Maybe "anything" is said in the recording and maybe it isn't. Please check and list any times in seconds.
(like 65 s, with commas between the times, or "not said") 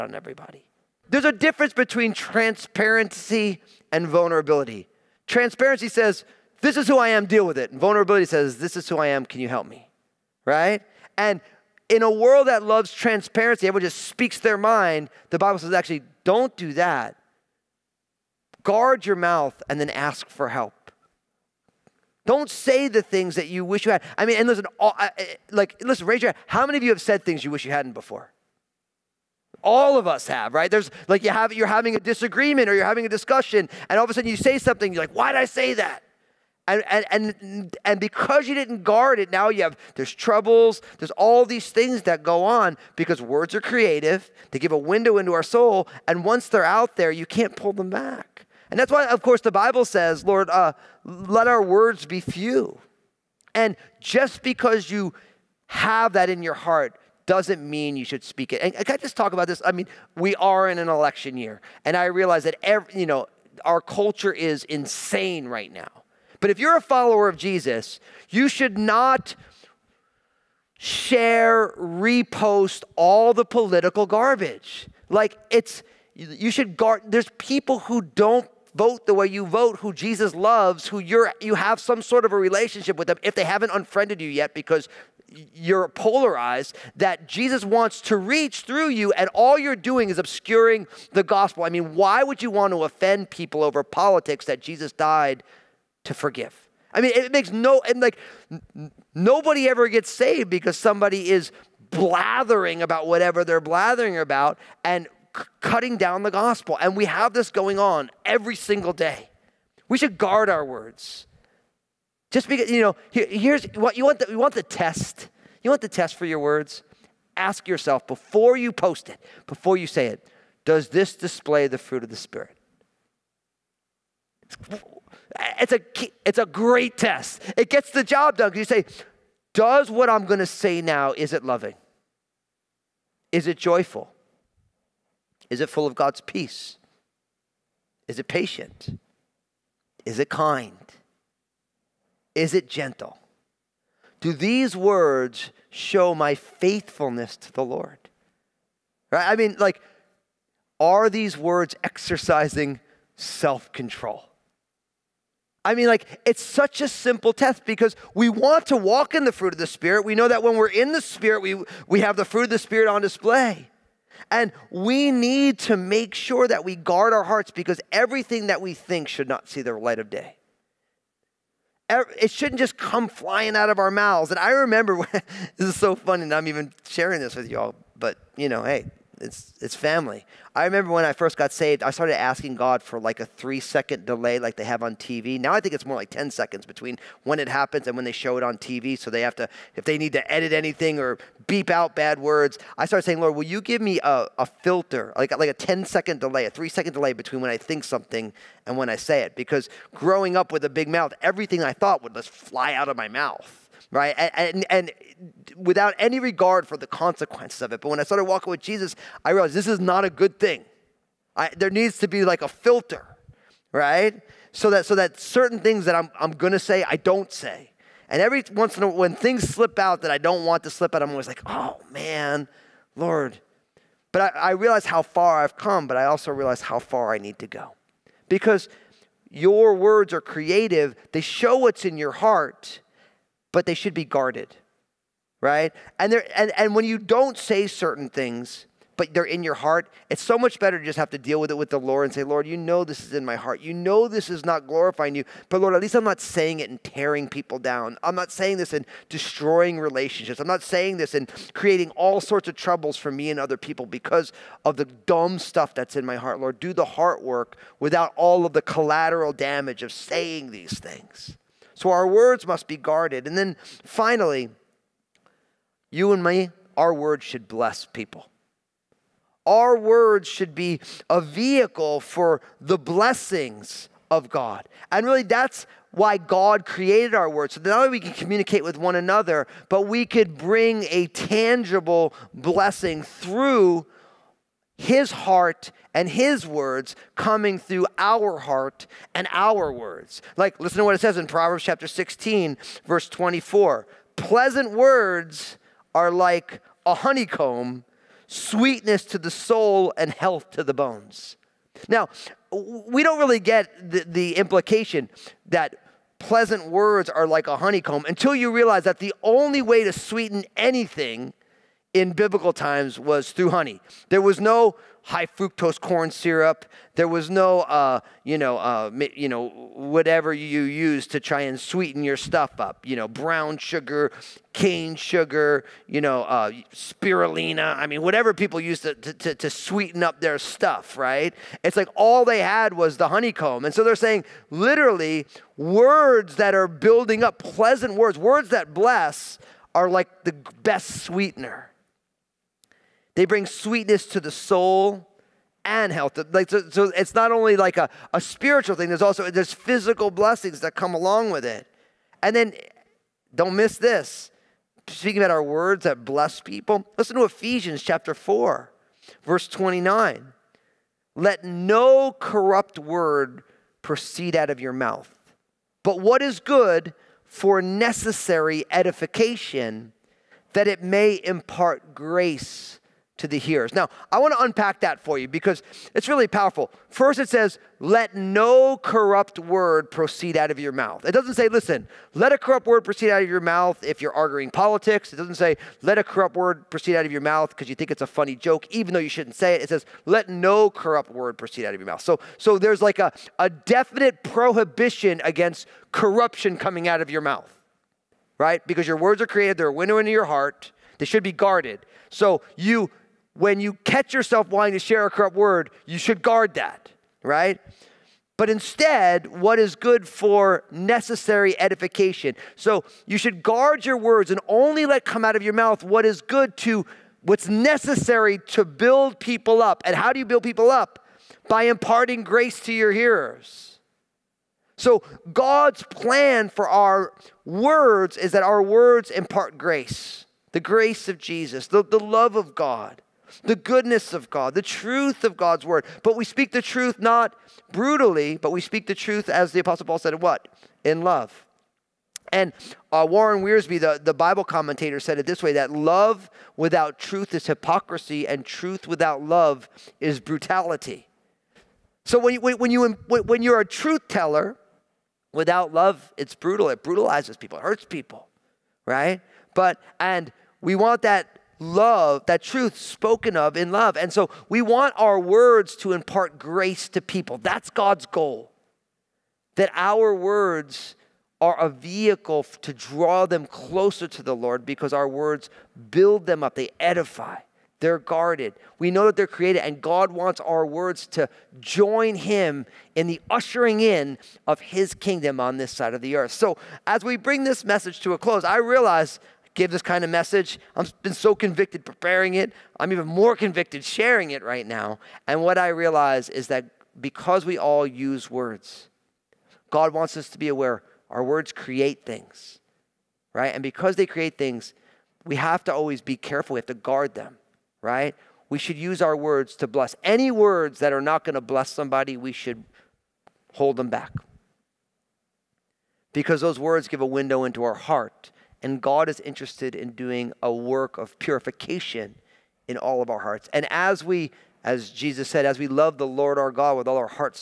190 s, 310 s.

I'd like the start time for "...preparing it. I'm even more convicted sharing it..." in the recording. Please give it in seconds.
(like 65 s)
491 s.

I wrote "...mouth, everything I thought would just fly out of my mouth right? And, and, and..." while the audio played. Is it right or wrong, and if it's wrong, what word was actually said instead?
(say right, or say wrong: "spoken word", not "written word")
right.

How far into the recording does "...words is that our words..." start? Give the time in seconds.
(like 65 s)
427 s.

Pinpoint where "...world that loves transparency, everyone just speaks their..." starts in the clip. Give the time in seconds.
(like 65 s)
12 s.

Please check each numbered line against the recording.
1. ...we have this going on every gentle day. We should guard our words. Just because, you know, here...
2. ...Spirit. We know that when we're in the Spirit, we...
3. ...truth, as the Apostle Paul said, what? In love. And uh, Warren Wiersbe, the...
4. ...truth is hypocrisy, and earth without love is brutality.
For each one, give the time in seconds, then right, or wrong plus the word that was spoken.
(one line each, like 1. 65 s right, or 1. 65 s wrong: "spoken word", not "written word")
1. 106 s wrong: "single", not "gentle"
2. 159 s right
3. 438 s right
4. 446 s wrong: "truth", not "earth".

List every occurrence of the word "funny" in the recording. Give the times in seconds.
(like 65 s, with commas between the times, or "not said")
175 s, 388 s.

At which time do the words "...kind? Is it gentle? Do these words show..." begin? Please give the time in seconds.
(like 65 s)
140 s.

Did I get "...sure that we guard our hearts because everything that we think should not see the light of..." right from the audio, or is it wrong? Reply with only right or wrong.
right.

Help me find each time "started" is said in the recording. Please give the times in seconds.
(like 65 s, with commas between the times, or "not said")
181 s, 192 s, 208 s.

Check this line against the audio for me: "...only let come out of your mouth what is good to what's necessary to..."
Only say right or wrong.
right.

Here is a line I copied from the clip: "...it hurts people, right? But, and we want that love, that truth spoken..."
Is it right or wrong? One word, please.
right.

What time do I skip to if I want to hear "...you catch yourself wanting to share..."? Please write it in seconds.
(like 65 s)
403 s.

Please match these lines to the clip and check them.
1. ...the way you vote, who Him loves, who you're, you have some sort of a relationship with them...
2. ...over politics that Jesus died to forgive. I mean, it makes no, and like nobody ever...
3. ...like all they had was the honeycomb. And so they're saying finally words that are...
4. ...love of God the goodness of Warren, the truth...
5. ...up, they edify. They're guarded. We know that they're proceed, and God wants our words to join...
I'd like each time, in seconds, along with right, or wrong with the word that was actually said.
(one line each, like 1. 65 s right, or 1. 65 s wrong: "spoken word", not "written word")
1. 79 s wrong: "Jesus", not "Him"
2. 93 s right
3. 331 s wrong: "literally", not "finally"
4. 432 s wrong: "God", not "Warren"
5. 476 s wrong: "created", not "proceed".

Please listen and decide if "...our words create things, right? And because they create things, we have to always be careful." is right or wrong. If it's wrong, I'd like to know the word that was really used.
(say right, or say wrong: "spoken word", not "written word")
right.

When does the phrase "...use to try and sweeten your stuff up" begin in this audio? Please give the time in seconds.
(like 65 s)
320 s.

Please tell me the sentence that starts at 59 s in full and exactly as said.
I mean, we are in an election year, and I realize that every, you know our culture is insane right now.